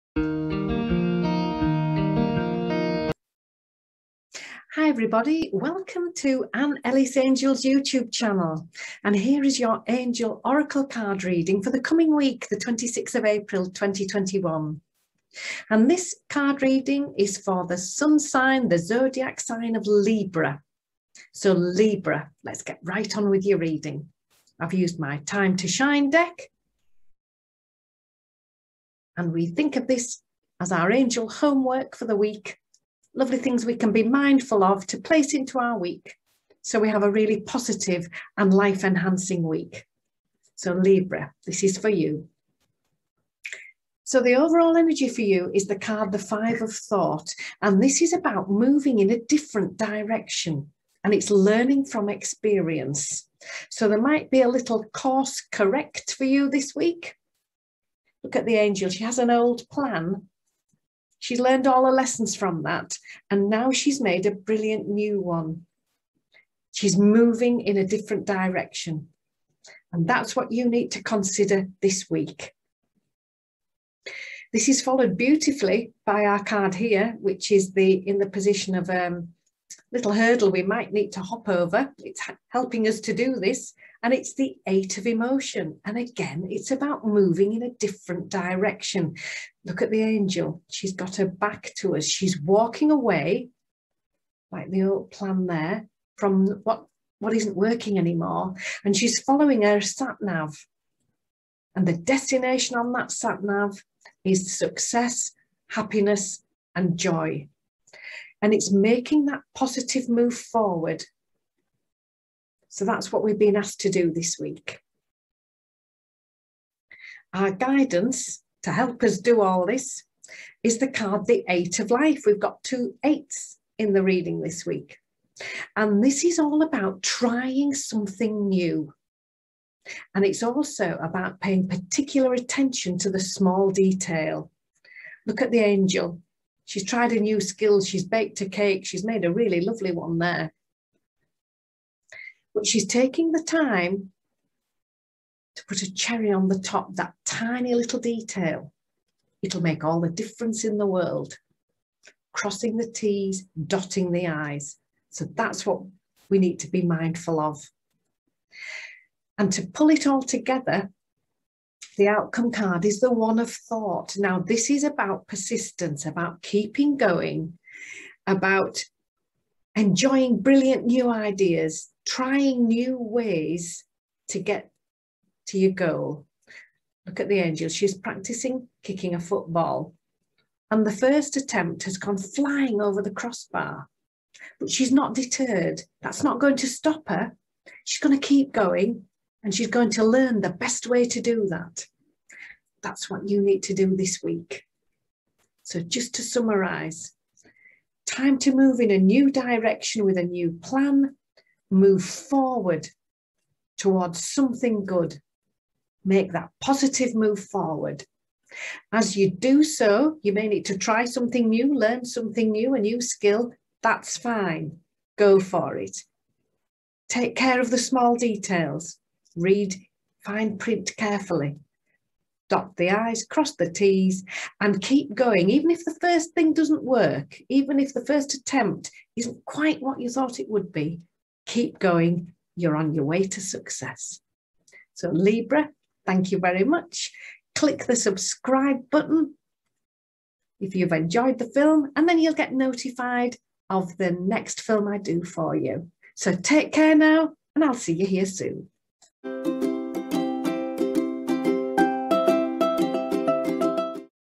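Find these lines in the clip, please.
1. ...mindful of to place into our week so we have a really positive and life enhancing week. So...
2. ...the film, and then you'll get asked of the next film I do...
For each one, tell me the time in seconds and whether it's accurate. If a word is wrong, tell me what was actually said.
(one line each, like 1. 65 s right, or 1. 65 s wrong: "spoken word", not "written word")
1. 34 s right
2. 241 s wrong: "notified", not "asked".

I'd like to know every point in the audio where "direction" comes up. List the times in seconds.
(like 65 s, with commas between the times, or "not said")
49 s, 68 s, 88 s, 199 s.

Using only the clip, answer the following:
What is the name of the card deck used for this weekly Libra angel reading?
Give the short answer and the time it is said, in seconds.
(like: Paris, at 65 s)
Time to Shine, at 25 s.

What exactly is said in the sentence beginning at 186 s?
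That's not going to stop her.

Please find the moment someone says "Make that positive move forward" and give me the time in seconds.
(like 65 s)
206 s.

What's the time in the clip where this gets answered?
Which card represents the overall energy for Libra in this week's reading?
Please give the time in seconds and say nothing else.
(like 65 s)
46 s.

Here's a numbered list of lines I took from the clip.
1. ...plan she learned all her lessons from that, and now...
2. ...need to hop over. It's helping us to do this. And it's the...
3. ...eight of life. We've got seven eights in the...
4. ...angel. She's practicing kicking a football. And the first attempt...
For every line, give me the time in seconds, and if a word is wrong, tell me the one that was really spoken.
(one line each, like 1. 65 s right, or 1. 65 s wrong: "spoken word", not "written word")
1. 59 s right
2. 80 s right
3. 121 s wrong: "two", not "seven"
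4. 177 s right.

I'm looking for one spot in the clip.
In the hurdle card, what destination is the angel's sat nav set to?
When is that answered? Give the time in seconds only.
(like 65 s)
104 s.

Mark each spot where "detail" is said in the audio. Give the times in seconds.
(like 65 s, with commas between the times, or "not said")
133 s, 147 s, 218 s.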